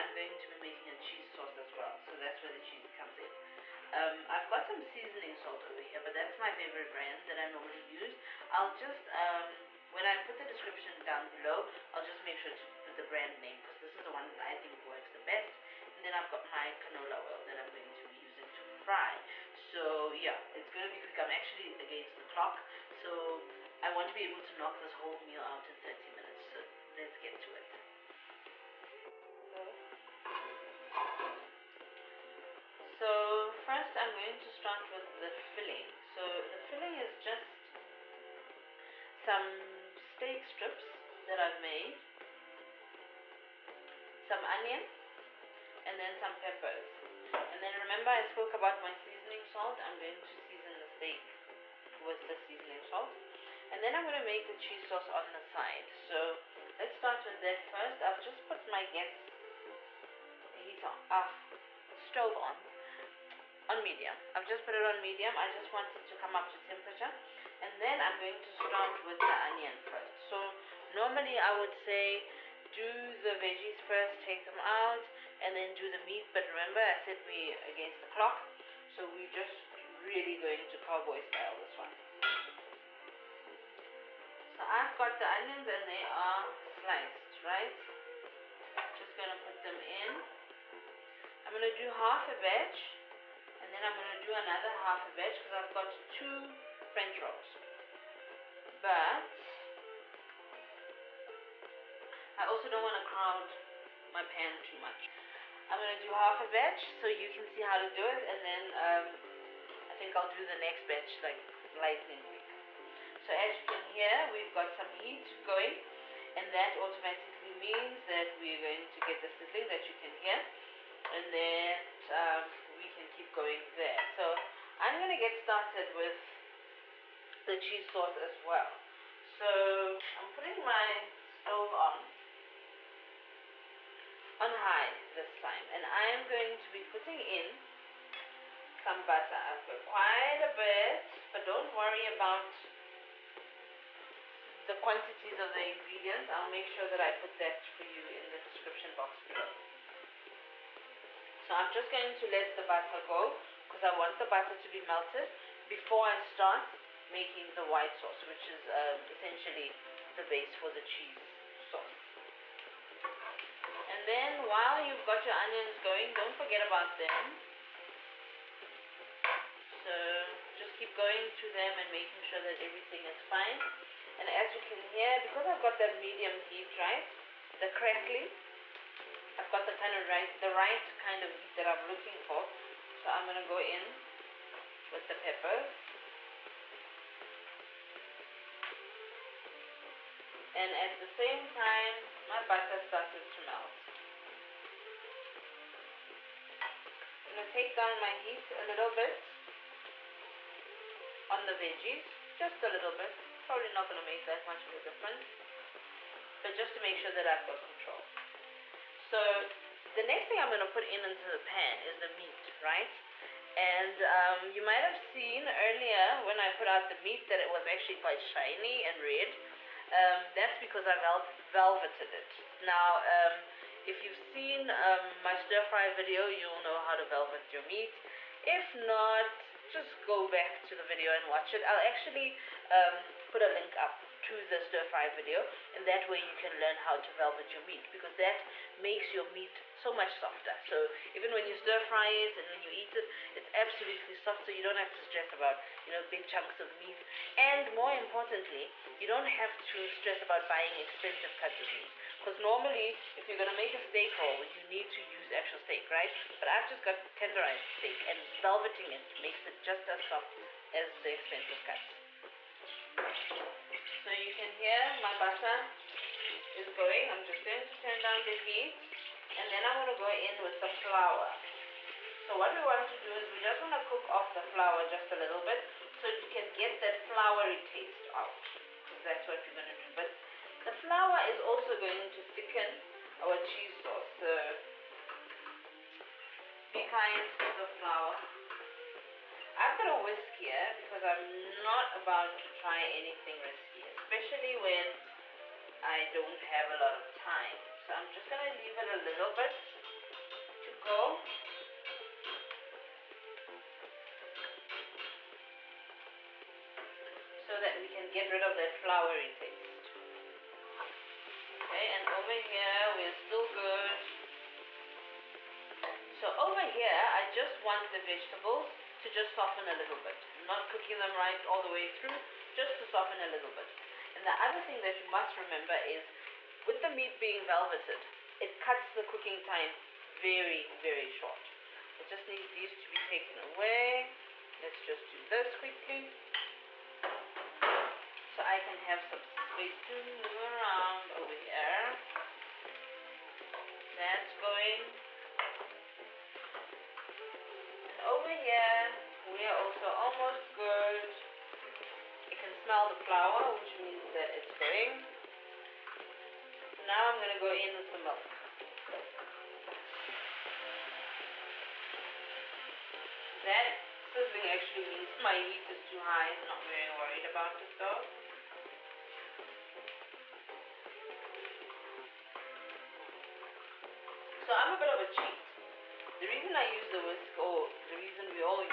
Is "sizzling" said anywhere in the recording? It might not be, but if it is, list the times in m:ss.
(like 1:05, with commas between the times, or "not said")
1:59, 6:04.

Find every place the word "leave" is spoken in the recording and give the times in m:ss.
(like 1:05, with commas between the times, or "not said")
4:58.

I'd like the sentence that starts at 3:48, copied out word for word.
If not, just go back to the video and watch it.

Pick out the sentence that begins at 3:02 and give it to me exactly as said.
So I'm gonna go in with the peppers.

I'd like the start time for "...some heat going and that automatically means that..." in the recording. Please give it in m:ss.
1:54.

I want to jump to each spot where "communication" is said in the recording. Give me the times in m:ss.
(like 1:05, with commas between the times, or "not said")
not said.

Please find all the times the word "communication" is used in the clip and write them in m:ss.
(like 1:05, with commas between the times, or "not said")
not said.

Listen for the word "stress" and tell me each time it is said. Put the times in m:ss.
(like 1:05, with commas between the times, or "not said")
4:04, 4:09.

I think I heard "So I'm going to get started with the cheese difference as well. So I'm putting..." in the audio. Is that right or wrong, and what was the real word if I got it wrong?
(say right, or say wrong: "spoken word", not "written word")
wrong: "sauce", not "difference".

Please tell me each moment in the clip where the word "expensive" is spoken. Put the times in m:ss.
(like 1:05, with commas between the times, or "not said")
4:10, 4:21.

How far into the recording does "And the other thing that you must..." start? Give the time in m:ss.
5:24.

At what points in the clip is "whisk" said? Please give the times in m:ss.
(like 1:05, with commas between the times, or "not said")
4:50, 6:17.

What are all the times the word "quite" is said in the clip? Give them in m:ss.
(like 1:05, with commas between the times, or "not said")
2:19, 3:38.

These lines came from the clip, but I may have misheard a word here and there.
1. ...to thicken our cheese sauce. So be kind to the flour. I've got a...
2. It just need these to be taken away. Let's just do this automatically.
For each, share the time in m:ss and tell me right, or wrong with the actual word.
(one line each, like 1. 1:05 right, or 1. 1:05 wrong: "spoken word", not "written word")
1. 4:42 right
2. 5:32 wrong: "quickly", not "automatically".